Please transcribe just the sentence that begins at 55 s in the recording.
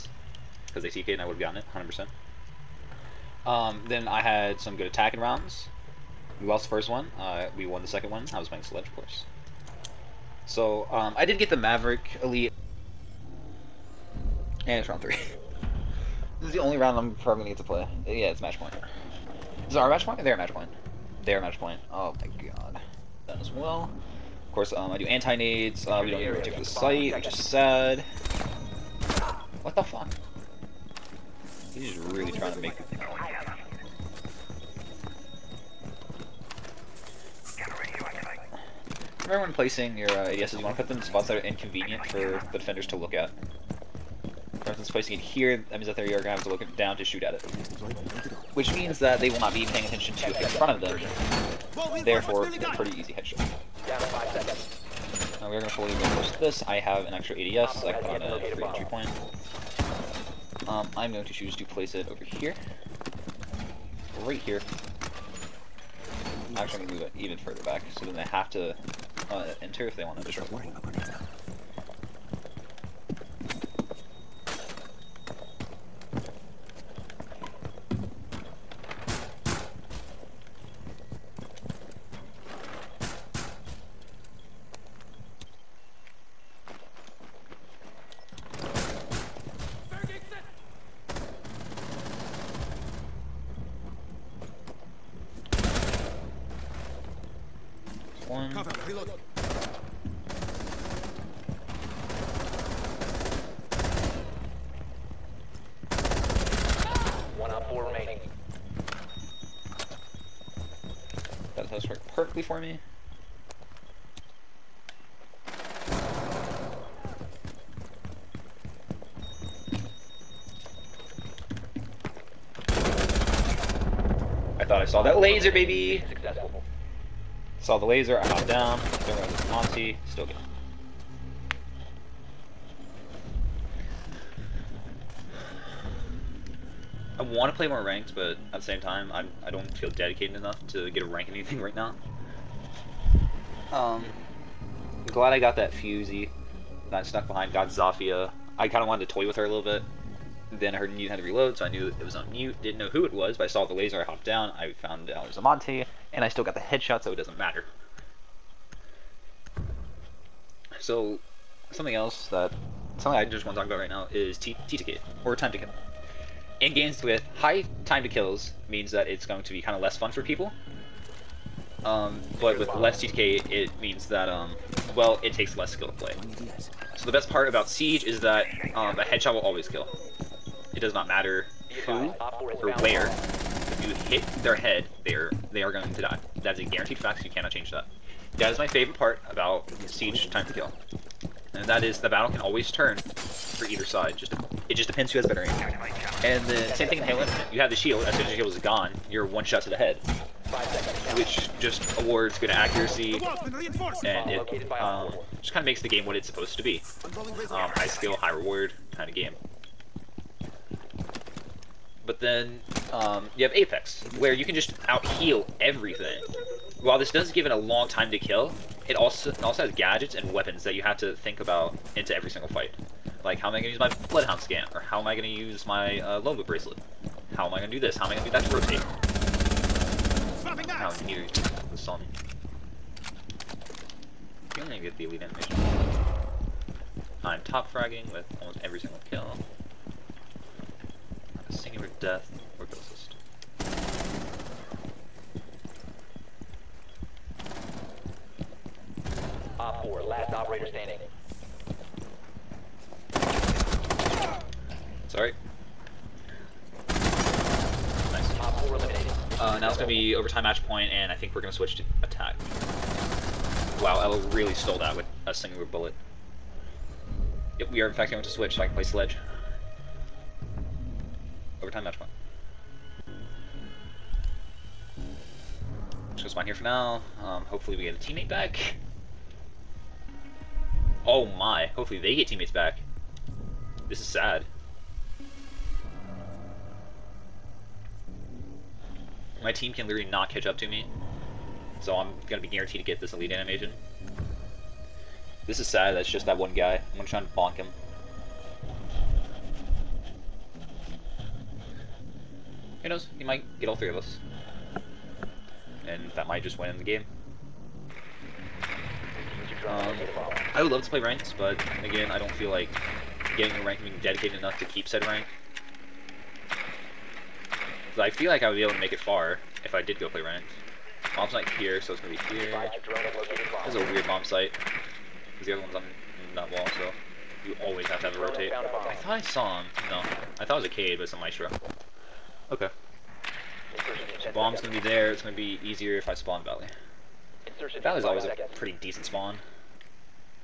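Uh, we are going to fully reinforce this.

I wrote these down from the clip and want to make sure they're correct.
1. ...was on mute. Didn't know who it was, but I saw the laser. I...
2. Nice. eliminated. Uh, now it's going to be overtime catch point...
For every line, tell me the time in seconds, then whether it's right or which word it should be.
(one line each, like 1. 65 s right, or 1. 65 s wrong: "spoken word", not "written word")
1. 152 s right
2. 258 s wrong: "match", not "catch".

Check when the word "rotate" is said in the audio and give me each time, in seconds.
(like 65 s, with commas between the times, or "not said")
228 s, 328 s.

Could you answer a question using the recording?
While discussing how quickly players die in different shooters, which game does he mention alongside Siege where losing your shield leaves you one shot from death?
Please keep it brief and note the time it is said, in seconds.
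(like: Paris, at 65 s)
Halo Infinite, at 197 s.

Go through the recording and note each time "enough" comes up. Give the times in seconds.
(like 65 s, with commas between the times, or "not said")
140 s, 314 s.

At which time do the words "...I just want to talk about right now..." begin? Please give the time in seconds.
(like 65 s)
163 s.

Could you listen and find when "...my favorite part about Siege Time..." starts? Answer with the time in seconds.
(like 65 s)
188 s.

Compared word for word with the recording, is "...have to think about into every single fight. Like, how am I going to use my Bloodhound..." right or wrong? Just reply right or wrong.
right.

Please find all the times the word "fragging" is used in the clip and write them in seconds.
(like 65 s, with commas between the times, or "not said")
237 s.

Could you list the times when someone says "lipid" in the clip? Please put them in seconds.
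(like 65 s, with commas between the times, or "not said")
not said.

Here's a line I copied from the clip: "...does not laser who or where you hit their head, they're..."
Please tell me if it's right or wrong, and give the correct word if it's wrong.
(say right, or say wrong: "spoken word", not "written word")
wrong: "matter", not "laser".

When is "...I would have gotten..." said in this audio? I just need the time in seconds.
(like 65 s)
1 s.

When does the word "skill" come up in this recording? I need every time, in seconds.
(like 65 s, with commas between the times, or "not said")
175 s, 207 s.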